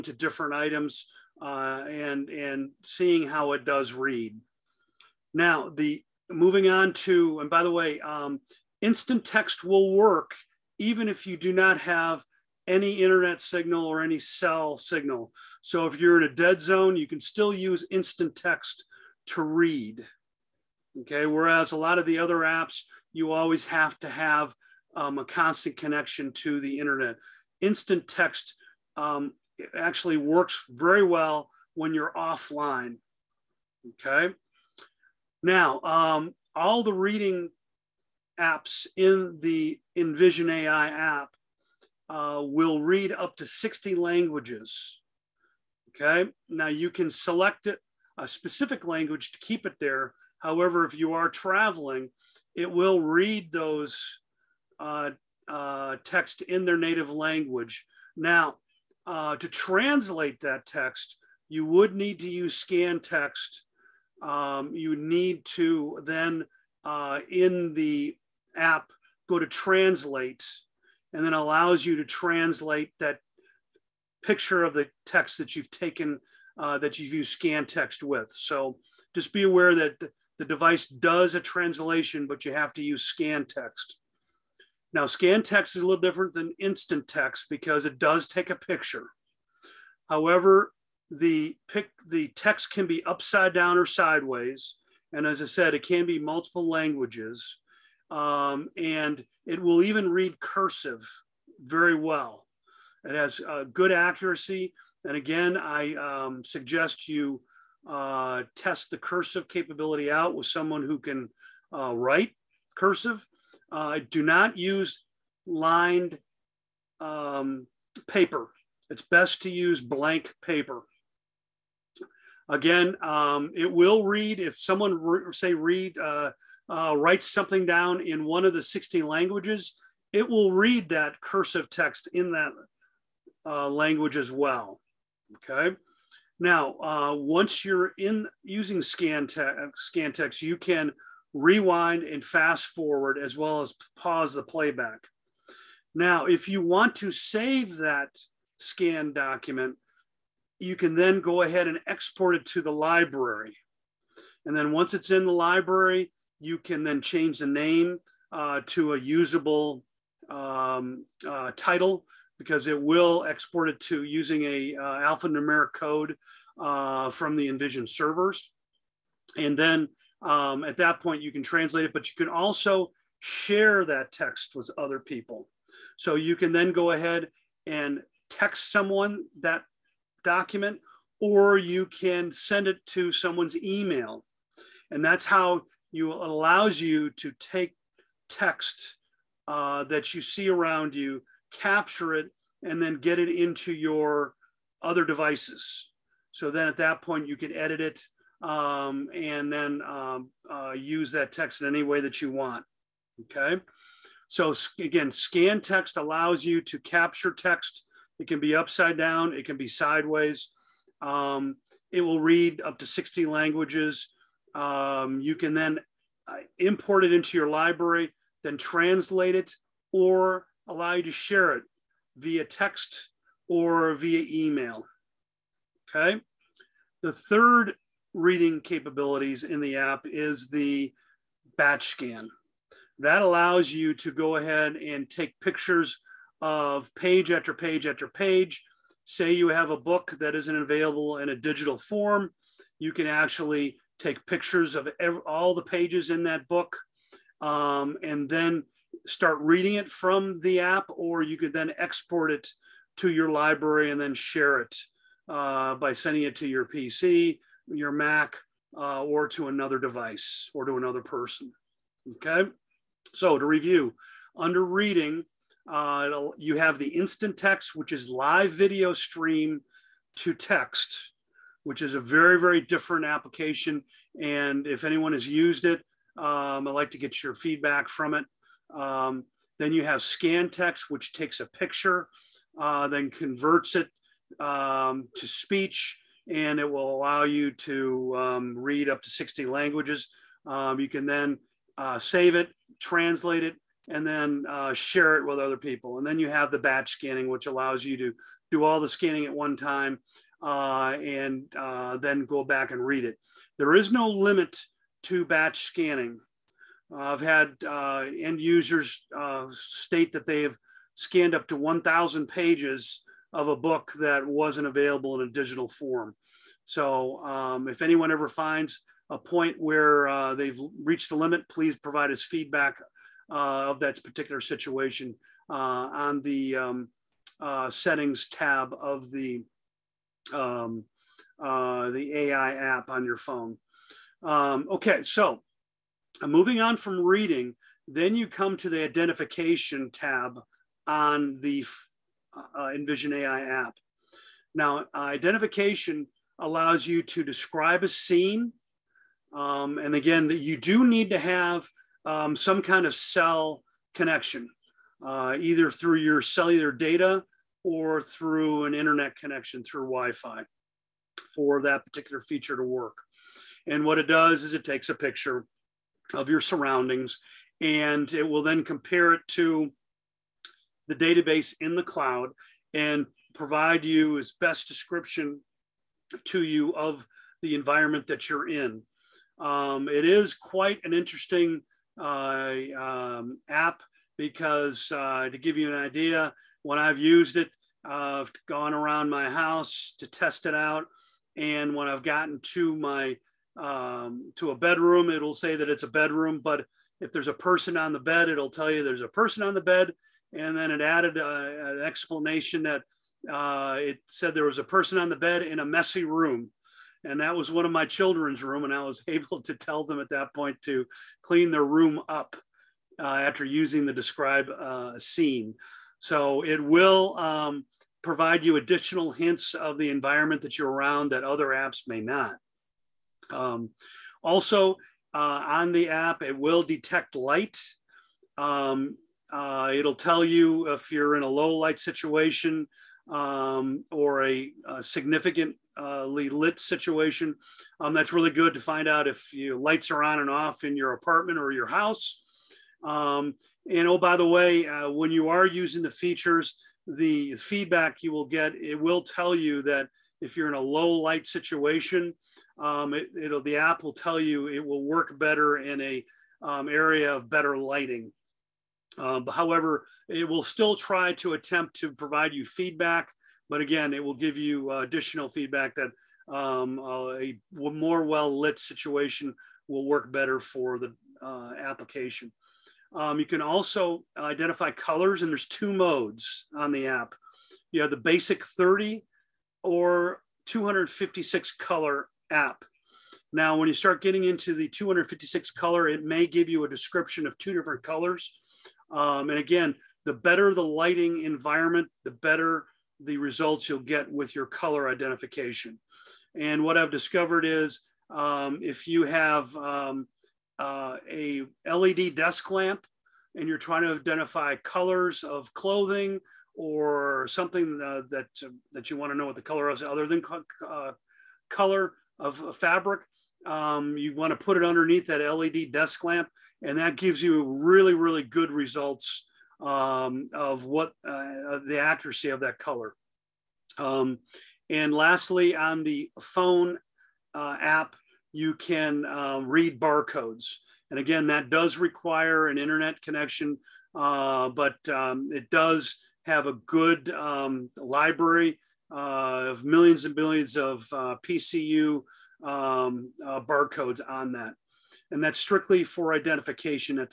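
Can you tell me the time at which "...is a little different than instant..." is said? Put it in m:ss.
1:25.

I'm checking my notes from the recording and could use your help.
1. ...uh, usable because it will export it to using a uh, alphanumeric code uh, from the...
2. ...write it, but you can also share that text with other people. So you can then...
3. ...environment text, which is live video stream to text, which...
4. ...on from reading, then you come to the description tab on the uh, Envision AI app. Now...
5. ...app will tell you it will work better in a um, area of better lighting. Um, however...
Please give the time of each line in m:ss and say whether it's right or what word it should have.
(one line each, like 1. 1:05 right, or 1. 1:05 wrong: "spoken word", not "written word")
1. 2:41 wrong: "title", not "usable"
2. 2:51 wrong: "translate", not "write"
3. 4:26 wrong: "instant", not "environment"
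4. 5:36 wrong: "identification", not "description"
5. 7:33 right.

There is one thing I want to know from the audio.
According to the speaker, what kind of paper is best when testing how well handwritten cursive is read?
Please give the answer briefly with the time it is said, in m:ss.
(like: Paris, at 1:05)
Blank paper, at 1:59.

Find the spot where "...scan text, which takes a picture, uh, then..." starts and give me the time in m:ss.
4:40.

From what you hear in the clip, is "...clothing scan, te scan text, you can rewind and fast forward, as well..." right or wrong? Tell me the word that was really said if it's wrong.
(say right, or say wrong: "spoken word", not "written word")
wrong: "using", not "clothing".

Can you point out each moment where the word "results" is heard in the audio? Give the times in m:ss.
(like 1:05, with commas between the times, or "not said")
8:13, 8:38.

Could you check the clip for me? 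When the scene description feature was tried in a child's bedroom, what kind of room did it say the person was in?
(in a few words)
A messy room.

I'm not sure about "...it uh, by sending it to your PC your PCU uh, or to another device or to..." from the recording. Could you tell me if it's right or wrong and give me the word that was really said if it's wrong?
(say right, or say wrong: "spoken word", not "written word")
wrong: "Mac", not "PCU".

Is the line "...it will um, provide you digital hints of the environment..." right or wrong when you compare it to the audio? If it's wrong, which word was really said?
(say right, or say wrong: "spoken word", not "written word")
wrong: "additional", not "digital".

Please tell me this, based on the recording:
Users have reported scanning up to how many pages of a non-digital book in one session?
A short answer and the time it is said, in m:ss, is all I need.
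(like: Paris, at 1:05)
1,000, at 5:11.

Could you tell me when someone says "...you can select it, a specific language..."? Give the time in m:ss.
0:46.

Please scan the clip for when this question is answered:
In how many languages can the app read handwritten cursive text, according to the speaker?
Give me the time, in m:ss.
2:08.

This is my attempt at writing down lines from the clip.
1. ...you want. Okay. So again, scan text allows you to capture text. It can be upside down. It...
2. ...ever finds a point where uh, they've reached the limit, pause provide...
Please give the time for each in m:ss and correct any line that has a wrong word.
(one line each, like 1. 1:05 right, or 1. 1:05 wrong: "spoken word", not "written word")
1. 3:22 right
2. 5:18 wrong: "please", not "pause".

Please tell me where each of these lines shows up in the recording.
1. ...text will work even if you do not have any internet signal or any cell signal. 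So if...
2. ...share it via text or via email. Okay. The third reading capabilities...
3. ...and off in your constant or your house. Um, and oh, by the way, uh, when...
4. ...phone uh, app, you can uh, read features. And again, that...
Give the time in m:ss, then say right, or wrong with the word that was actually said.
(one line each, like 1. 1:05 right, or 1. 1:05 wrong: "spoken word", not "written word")
1. 0:09 right
2. 3:41 right
3. 7:20 wrong: "apartment", not "constant"
4. 8:46 wrong: "barcodes", not "features".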